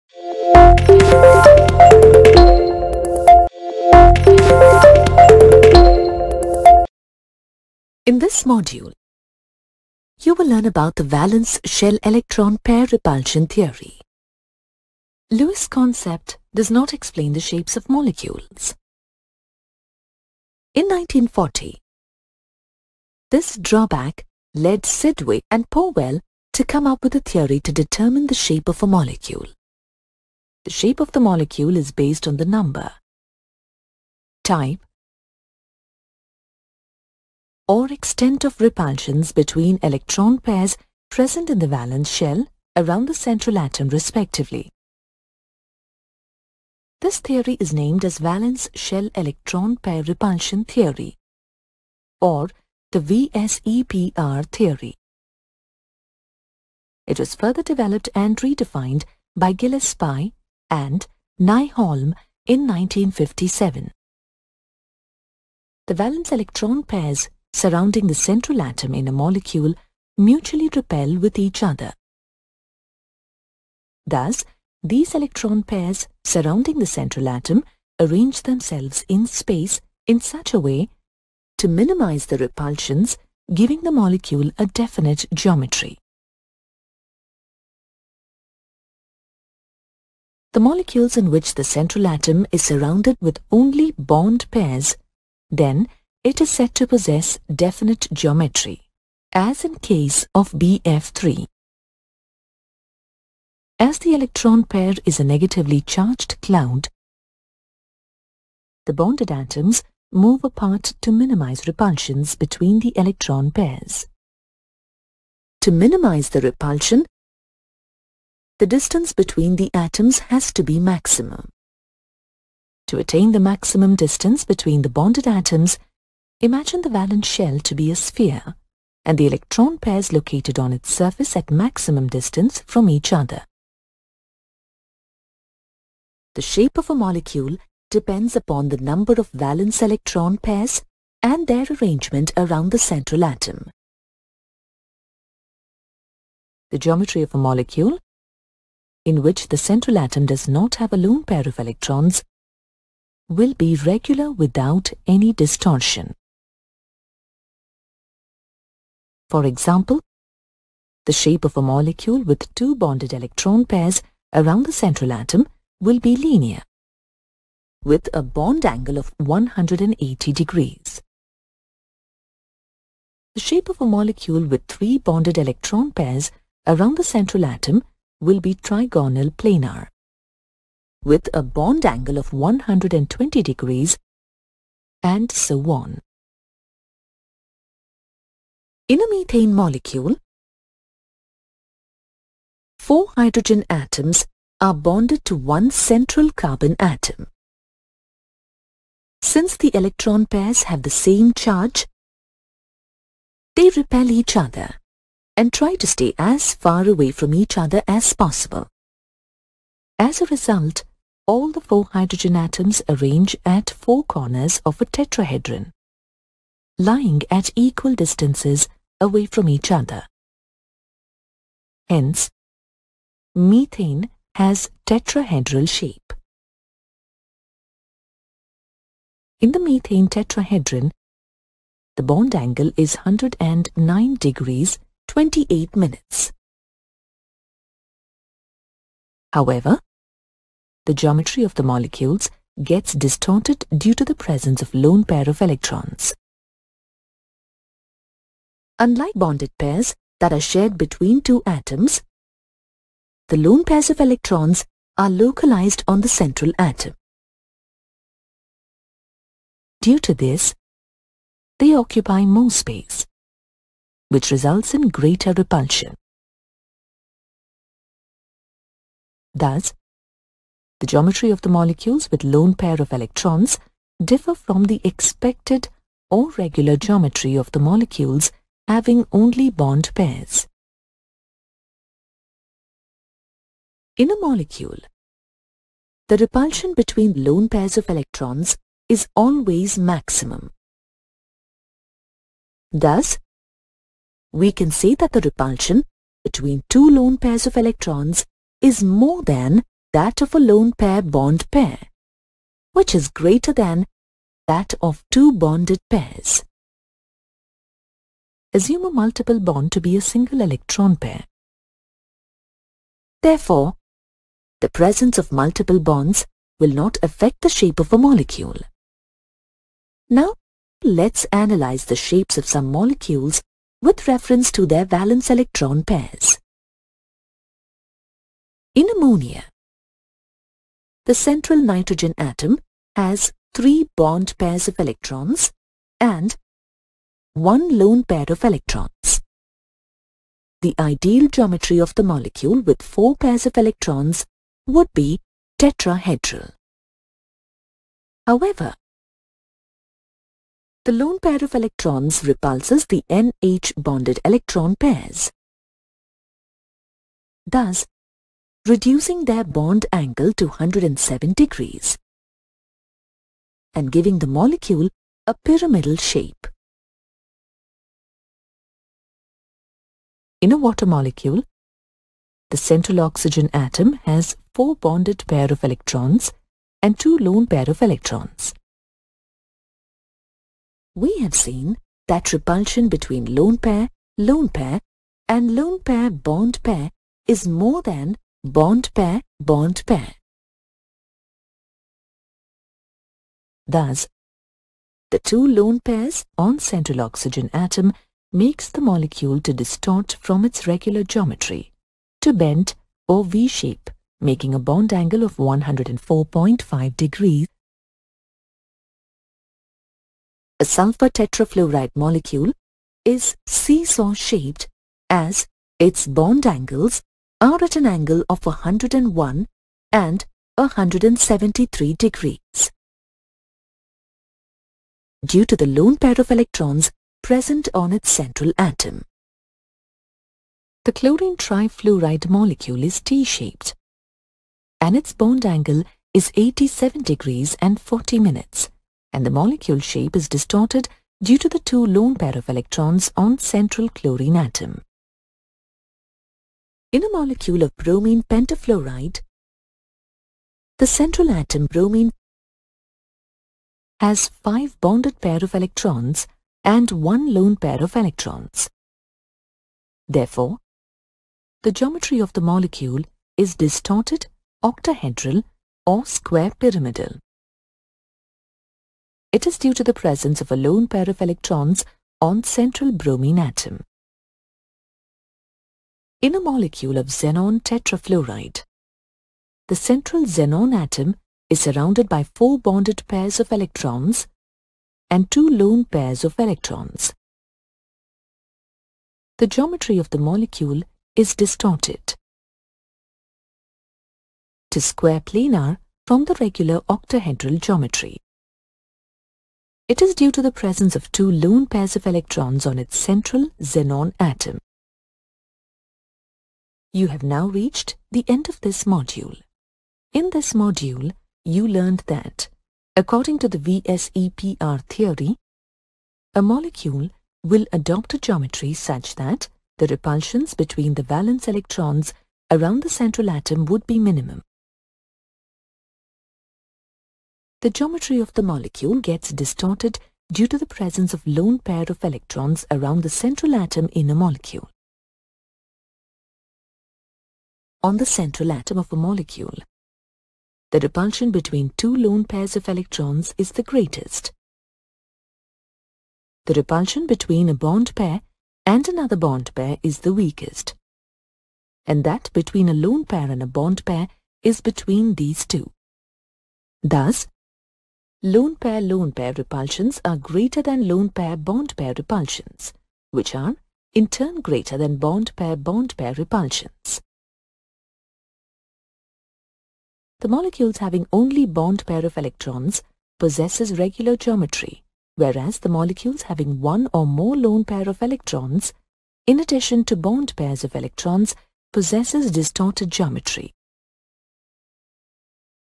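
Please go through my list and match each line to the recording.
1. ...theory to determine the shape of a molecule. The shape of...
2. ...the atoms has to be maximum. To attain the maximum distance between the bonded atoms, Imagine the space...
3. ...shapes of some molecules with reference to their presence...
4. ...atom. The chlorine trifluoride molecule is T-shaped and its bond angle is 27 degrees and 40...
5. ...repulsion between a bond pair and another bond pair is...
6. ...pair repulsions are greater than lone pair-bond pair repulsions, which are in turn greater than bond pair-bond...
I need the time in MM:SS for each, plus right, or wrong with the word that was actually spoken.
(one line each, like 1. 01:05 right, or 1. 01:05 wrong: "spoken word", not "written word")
1. 00:27 right
2. 01:59 wrong: "valence", not "space"
3. 05:21 wrong: "valence", not "presence"
4. 07:08 wrong: "87", not "27"
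5. 09:06 right
6. 09:19 right.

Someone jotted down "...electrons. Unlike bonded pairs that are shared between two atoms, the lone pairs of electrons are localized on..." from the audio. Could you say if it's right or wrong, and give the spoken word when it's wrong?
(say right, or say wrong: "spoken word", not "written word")
right.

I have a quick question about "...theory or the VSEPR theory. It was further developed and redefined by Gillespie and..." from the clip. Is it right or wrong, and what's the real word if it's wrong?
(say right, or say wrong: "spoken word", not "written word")
right.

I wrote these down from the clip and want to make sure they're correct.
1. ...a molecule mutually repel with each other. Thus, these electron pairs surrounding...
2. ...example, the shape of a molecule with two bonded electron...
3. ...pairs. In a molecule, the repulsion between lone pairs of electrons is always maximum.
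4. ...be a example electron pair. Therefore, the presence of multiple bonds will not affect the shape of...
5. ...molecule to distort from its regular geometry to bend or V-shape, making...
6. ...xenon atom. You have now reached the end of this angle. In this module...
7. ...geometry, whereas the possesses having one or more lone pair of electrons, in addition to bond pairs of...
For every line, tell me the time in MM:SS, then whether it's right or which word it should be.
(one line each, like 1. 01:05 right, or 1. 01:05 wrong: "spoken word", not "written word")
1. 01:09 right
2. 02:39 right
3. 04:39 right
4. 05:09 wrong: "single", not "example"
5. 06:38 right
6. 08:23 wrong: "module", not "angle"
7. 09:34 wrong: "molecules", not "possesses".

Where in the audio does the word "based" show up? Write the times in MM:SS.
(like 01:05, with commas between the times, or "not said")
00:31.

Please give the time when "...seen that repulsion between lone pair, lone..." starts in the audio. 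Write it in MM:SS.
06:21.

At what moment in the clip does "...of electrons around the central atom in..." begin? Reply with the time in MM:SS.
08:51.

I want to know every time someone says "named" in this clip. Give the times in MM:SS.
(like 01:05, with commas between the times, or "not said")
00:47.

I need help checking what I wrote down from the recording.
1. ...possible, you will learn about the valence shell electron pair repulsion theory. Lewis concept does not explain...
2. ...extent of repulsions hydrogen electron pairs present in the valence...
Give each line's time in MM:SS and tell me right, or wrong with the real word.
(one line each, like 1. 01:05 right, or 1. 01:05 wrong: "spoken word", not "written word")
1. 00:08 wrong: "module", not "possible"
2. 00:37 wrong: "between", not "hydrogen".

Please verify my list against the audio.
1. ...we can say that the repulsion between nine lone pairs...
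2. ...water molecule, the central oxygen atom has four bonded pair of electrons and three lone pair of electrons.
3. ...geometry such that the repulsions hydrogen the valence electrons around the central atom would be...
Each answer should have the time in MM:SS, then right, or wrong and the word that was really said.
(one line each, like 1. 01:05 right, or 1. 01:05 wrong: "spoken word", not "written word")
1. 04:54 wrong: "two", not "nine"
2. 06:10 wrong: "two", not "three"
3. 08:38 wrong: "between", not "hydrogen".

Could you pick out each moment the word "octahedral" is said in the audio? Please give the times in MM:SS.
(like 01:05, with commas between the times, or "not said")
07:44, 08:16.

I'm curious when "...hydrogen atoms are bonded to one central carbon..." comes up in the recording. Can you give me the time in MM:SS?
03:13.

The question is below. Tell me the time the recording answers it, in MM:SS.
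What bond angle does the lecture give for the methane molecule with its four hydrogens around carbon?
03:52.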